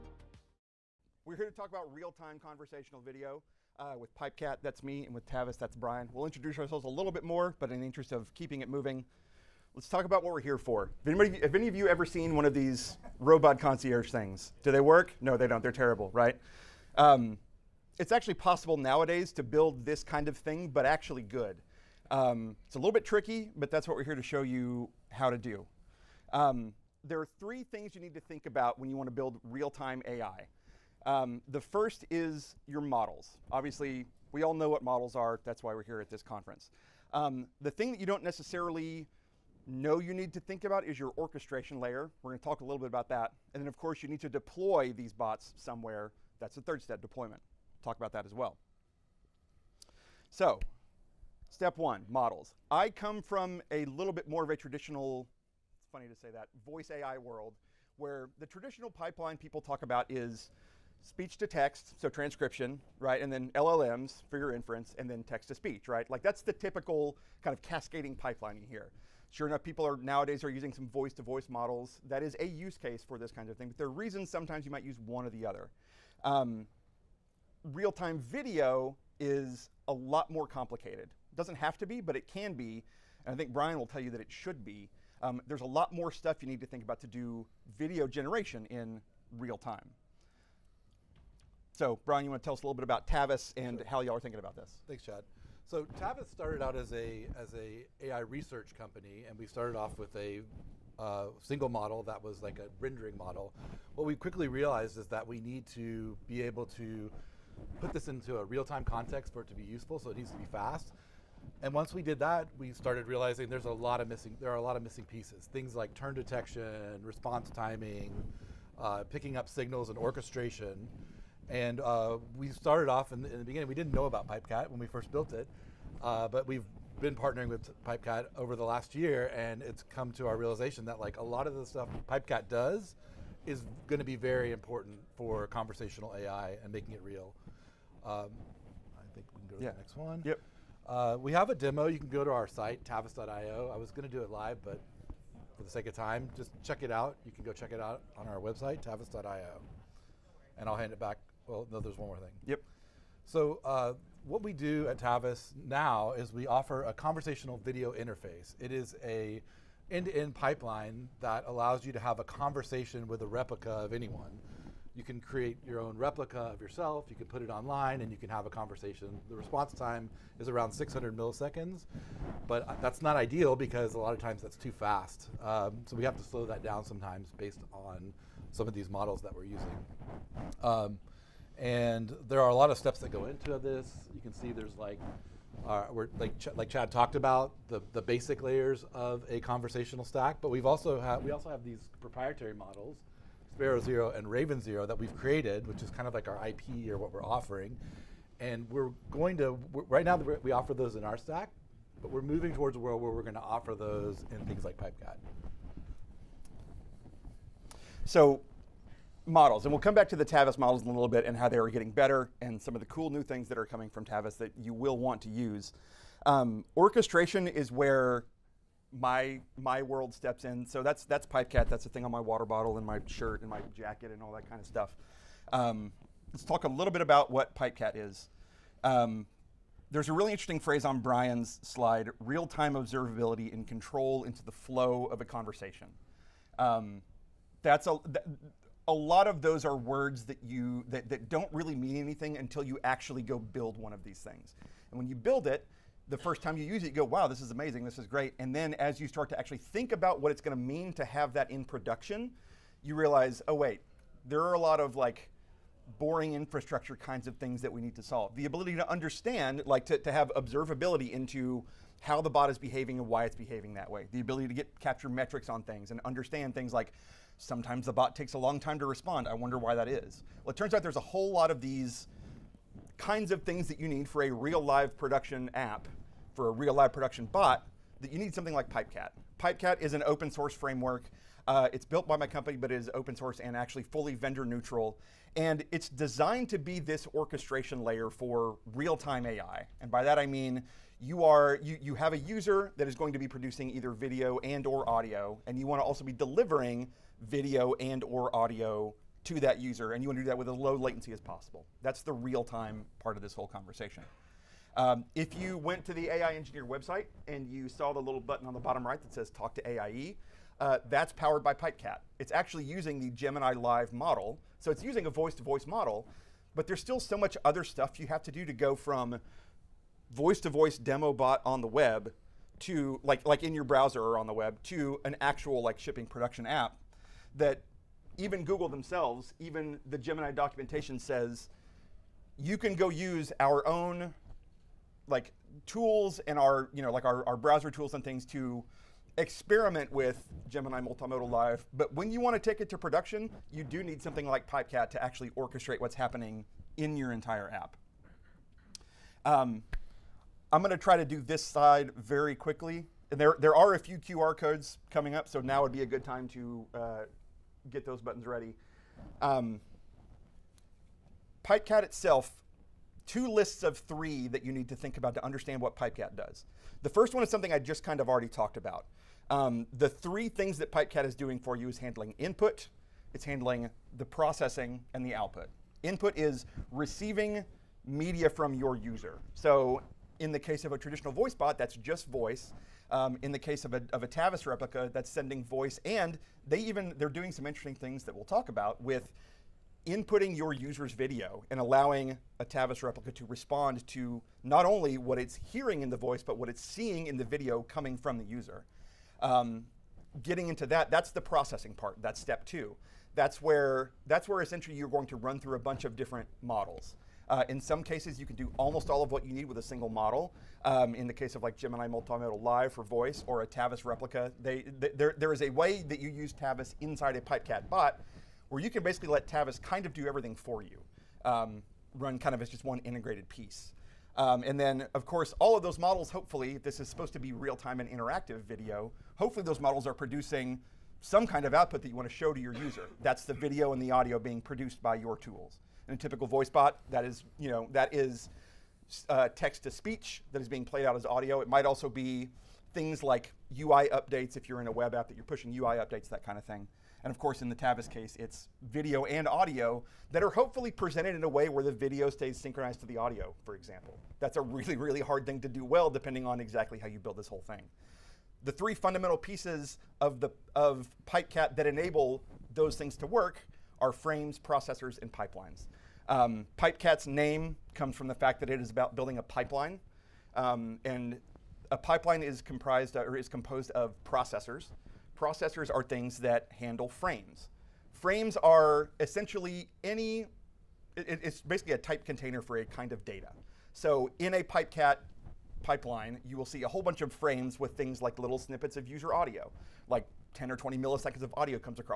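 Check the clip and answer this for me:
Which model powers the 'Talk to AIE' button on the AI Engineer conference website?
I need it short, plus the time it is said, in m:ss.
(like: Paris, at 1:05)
Gemini Live, at 5:13.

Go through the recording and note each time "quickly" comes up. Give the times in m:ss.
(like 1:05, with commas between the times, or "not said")
1:44, 5:52.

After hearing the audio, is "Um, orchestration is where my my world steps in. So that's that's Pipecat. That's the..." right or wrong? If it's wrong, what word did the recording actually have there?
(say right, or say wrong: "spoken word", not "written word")
right.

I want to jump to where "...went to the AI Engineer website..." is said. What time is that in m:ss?
5:05.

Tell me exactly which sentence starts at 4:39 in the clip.
Pipecat is an open source framework.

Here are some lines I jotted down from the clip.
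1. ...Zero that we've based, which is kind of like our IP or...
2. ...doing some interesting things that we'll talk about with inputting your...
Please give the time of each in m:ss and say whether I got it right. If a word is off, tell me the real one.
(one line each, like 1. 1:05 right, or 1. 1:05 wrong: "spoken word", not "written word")
1. 3:14 wrong: "created", not "based"
2. 6:27 right.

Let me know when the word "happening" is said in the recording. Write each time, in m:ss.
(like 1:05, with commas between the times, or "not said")
5:45.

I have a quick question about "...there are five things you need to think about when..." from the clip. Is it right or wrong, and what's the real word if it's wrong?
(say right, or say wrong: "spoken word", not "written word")
wrong: "three", not "five".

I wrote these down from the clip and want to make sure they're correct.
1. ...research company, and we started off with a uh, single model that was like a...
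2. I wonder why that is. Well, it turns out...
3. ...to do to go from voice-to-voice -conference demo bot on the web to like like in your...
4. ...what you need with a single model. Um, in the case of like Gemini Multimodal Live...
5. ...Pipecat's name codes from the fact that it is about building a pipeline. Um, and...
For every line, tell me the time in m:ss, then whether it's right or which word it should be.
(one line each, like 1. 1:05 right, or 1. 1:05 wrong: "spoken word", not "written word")
1. 1:38 right
2. 4:29 right
3. 5:18 wrong: "voice", not "conference"
4. 6:49 right
5. 7:46 wrong: "comes", not "codes".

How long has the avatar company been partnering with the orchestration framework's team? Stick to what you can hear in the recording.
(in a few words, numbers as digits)
the last year.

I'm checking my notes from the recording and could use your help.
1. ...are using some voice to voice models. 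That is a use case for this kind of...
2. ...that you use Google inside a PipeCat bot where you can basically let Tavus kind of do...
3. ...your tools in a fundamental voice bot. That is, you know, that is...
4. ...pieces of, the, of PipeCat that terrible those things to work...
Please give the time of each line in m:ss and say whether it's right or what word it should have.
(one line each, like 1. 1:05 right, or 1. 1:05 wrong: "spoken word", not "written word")
1. 1:10 right
2. 6:55 wrong: "Tavus", not "Google"
3. 7:14 wrong: "typical", not "fundamental"
4. 7:39 wrong: "enable", not "terrible".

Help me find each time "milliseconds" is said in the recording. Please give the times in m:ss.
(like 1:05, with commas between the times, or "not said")
2:51, 8:10.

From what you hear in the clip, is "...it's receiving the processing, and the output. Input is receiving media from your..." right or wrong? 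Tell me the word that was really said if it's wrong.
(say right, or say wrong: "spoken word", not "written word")
wrong: "handling", not "receiving".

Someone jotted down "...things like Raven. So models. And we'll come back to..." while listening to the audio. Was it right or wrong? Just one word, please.
wrong.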